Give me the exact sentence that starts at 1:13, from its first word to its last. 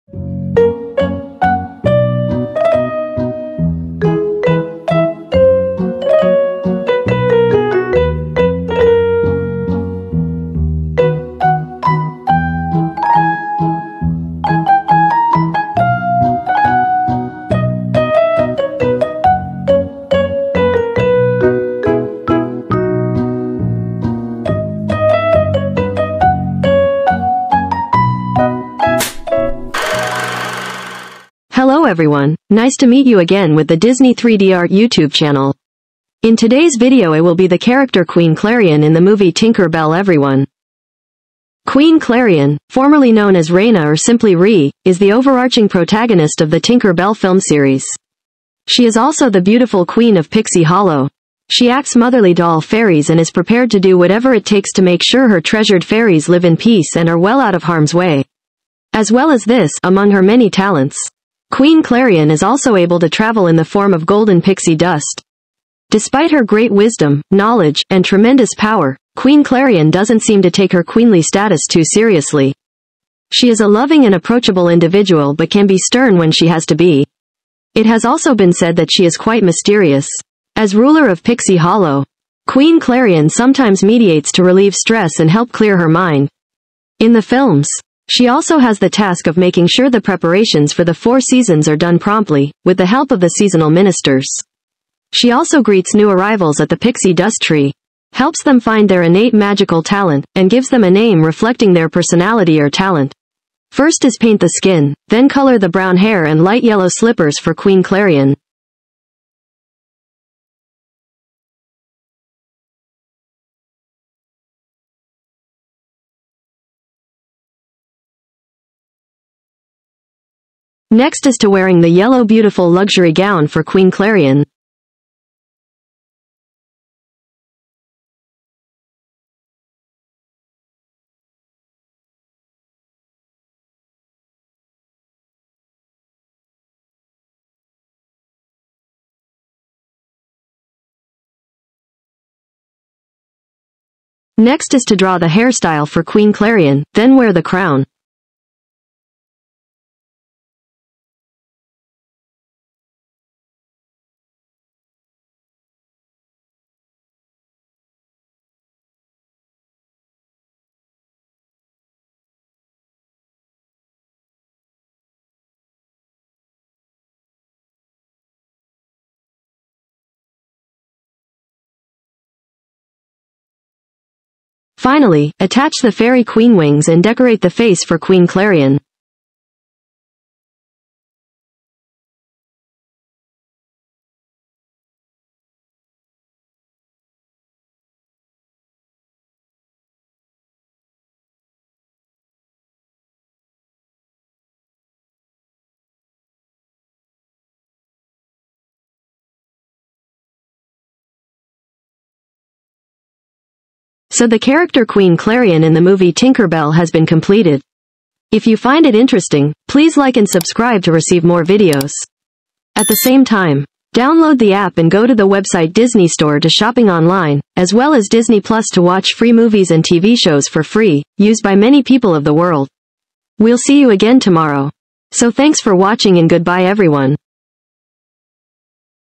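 She is a loving and approachable individual but can be stern when she has to be.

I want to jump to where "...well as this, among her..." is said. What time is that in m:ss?
0:59.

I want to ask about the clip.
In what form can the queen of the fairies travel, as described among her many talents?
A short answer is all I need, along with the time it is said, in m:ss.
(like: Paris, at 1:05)
golden pixie dust, at 1:04.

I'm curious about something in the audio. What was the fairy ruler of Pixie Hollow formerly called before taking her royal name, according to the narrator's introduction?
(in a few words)
Reina.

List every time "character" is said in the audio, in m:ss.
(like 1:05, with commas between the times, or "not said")
0:37, 3:24.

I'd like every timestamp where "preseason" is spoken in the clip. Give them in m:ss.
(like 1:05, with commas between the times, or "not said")
not said.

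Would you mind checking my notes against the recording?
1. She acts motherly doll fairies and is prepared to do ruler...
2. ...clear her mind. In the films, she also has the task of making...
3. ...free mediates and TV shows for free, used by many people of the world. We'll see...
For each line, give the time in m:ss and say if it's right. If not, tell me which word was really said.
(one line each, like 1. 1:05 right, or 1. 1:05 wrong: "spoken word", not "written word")
1. 0:51 wrong: "whatever", not "ruler"
2. 1:25 right
3. 3:39 wrong: "movies", not "mediates".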